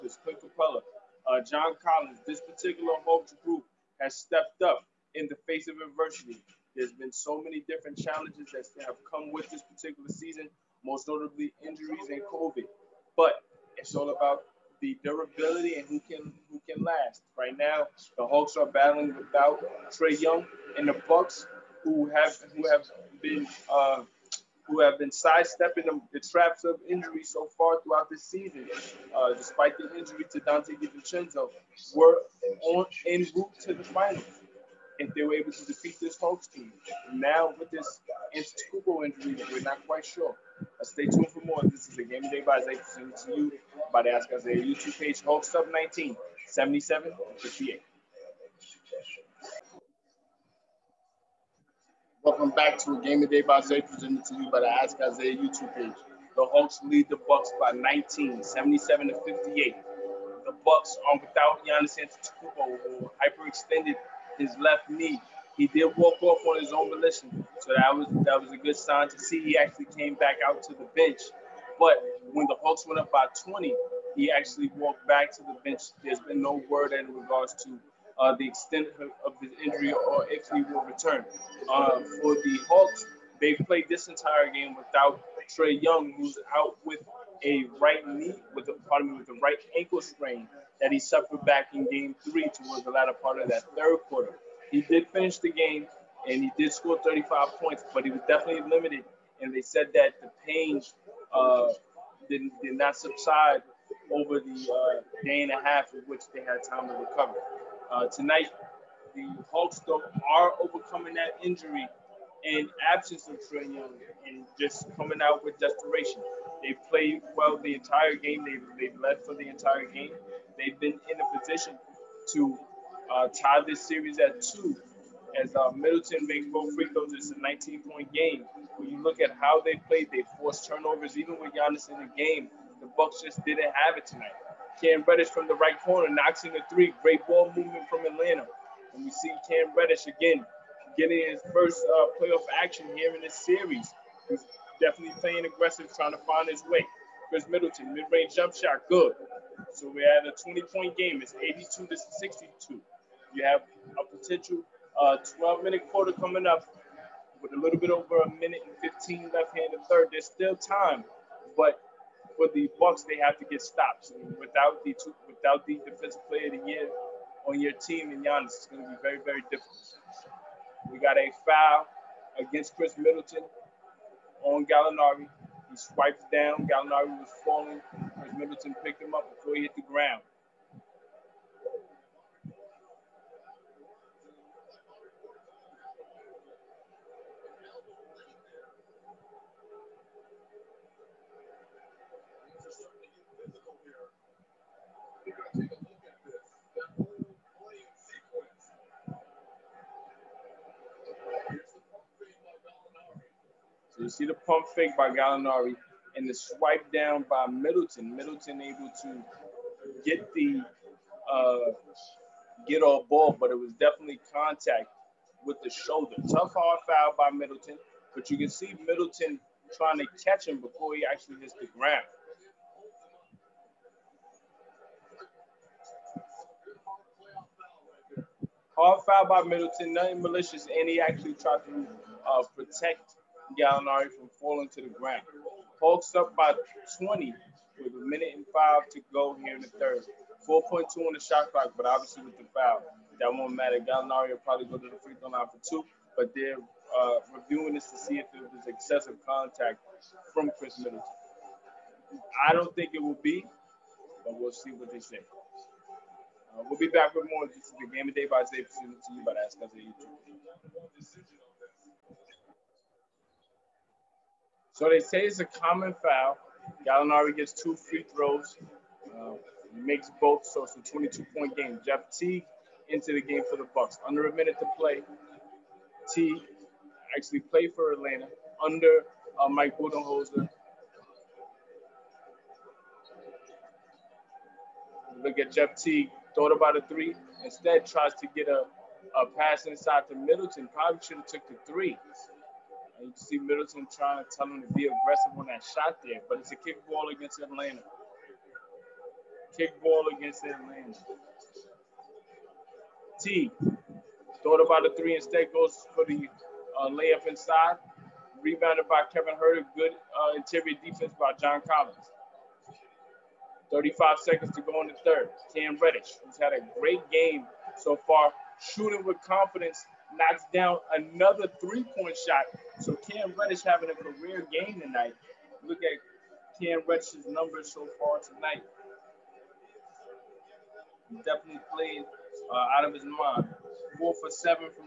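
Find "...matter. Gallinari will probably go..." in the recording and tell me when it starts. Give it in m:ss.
4:03.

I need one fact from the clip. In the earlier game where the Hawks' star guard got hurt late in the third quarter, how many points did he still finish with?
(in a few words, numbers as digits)
35.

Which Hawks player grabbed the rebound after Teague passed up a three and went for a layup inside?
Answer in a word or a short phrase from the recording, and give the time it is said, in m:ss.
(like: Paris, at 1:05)
Kevin Huerter, at 5:09.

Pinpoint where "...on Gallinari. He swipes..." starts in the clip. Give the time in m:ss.
2:54.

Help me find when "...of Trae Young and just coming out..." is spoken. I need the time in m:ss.
1:53.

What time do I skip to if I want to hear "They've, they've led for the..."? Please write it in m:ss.
1:58.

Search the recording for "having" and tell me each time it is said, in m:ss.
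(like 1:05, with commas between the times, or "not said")
5:23.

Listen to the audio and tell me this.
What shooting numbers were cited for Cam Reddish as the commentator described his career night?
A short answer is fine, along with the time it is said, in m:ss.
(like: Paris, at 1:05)
4 for 7, at 5:33.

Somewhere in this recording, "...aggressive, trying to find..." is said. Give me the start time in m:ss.
2:25.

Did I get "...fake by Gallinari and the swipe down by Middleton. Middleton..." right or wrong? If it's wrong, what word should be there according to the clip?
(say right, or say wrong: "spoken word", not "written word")
right.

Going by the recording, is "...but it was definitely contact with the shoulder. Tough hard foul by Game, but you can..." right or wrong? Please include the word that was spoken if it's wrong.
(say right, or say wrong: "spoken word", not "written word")
wrong: "Middleton", not "Game".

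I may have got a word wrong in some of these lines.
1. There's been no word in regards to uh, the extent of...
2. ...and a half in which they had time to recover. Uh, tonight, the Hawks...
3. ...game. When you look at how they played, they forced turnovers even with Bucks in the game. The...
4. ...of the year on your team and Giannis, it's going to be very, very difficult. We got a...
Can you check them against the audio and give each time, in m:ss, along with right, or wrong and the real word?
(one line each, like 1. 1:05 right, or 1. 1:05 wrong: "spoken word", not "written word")
1. 1:16 right
2. 1:45 right
3. 2:08 wrong: "Giannis", not "Bucks"
4. 2:46 right.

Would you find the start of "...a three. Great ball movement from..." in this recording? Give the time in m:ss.
2:16.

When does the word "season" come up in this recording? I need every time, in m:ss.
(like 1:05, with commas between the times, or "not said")
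0:10, 0:28.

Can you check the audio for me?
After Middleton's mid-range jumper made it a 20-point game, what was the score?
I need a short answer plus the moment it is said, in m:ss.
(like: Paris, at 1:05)
82 to 62, at 2:31.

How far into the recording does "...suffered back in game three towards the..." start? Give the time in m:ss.
1:30.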